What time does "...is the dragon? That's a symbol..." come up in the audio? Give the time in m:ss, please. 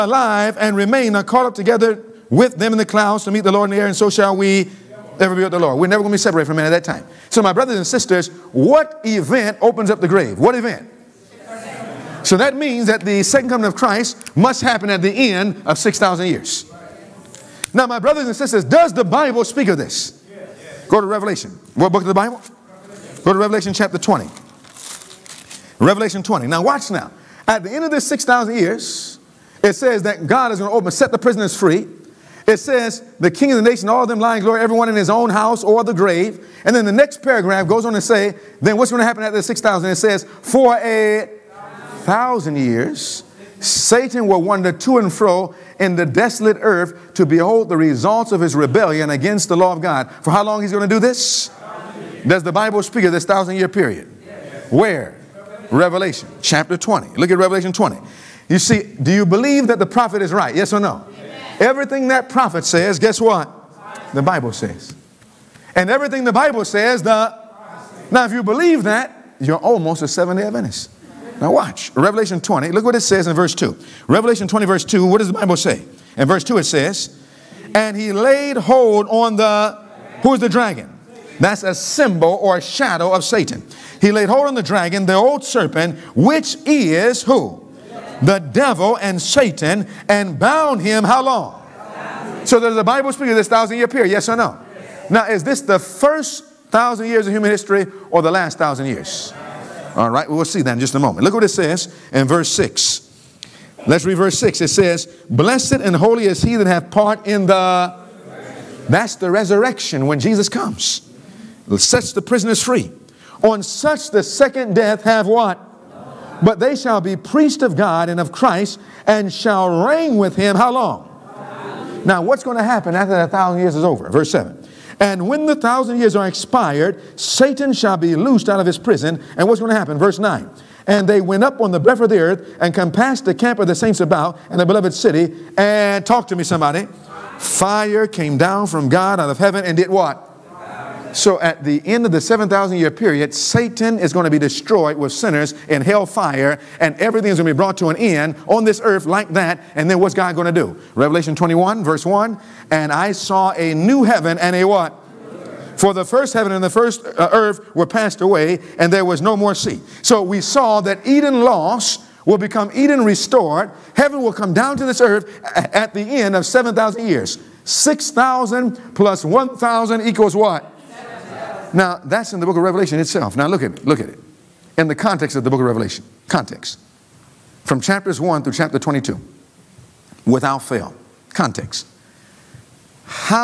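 1:20.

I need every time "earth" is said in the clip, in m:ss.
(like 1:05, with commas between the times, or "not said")
0:46, 2:12, 2:28, 2:37, 2:45.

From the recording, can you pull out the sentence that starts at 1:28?
the devil and Satan and bound him how long?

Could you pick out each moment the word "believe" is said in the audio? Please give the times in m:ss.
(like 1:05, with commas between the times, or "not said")
0:59, 1:08.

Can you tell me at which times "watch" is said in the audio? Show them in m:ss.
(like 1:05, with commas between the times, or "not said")
0:26, 1:11.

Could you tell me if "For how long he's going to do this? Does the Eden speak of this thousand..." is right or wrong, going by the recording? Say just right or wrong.
wrong.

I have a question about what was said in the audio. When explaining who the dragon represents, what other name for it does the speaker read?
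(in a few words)
the old serpent.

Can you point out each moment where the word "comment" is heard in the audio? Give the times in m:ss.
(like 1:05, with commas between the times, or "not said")
not said.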